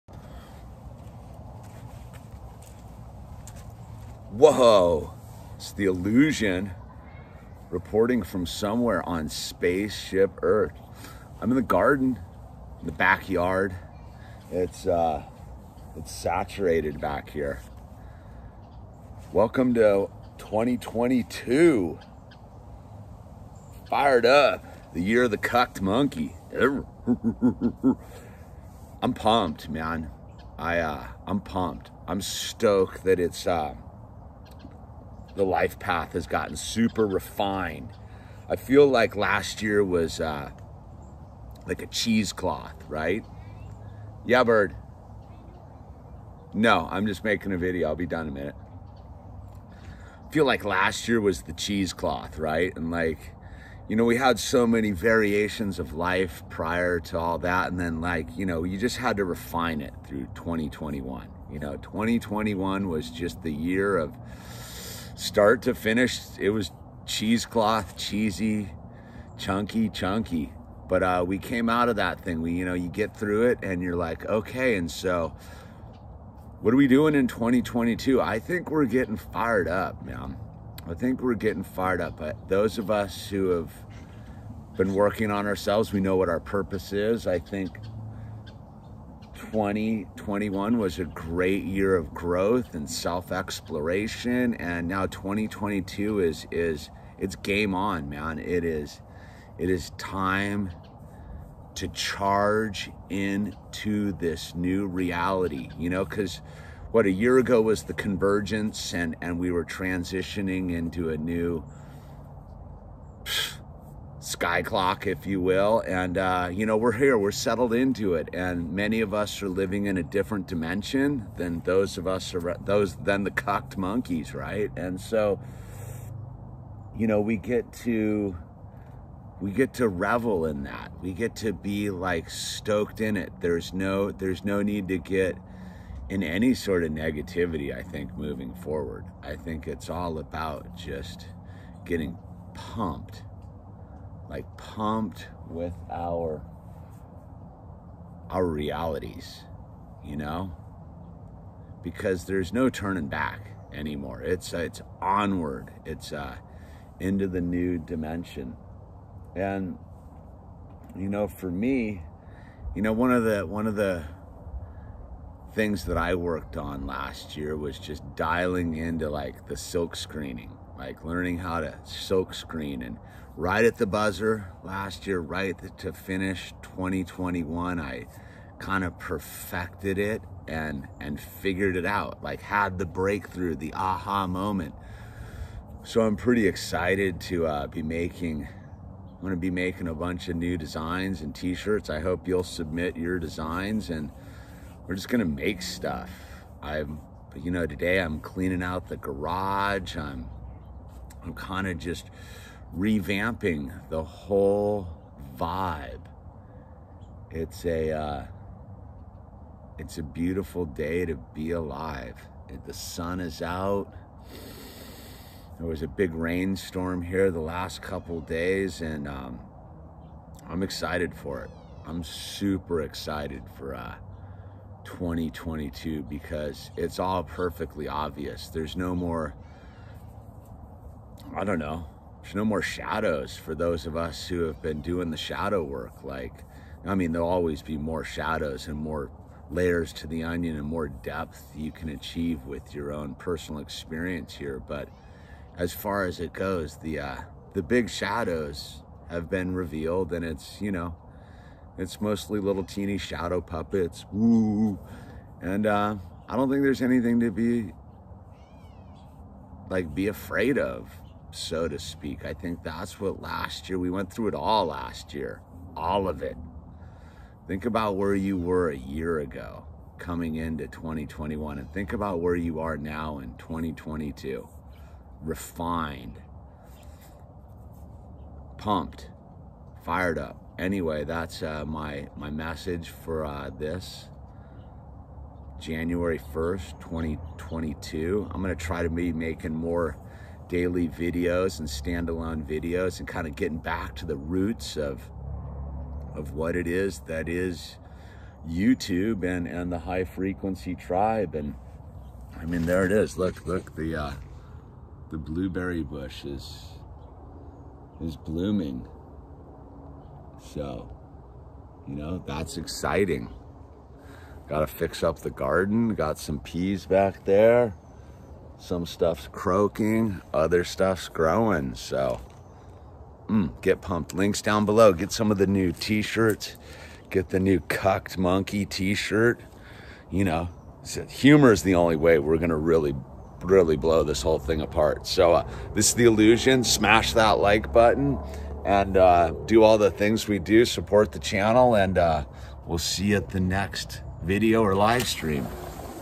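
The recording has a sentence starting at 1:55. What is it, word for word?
And, uh, you know, we're here, we're settled into it.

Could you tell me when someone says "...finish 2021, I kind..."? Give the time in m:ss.
2:55.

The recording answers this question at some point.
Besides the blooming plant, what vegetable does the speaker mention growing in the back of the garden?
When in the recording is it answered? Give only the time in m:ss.
5:16.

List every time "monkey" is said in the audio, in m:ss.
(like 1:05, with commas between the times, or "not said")
0:25, 2:03, 5:28.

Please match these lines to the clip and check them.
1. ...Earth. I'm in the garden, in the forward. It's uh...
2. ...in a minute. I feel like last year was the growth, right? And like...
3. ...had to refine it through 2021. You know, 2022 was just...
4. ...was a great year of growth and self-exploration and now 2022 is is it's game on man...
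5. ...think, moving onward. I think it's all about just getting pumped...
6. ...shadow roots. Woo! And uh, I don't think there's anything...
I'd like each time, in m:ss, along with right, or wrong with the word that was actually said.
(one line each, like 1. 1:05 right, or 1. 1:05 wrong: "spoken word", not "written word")
1. 0:10 wrong: "backyard", not "forward"
2. 0:48 wrong: "cheesecloth", not "growth"
3. 0:58 wrong: "2021", not "2022"
4. 1:30 right
5. 2:17 wrong: "forward", not "onward"
6. 4:12 wrong: "puppets", not "roots".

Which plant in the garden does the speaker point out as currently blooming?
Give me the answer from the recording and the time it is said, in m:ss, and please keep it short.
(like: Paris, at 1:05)
Blueberry bush, at 5:05.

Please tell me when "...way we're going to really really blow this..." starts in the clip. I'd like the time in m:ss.
5:31.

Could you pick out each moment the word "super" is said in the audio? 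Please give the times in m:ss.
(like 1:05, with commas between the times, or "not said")
0:36, 3:42.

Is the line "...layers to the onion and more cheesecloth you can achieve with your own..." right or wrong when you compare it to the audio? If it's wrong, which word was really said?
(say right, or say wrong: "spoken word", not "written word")
wrong: "depth", not "cheesecloth".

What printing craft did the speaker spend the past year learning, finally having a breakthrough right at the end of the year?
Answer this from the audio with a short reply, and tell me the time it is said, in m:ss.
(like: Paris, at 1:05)
Silk screening, at 2:49.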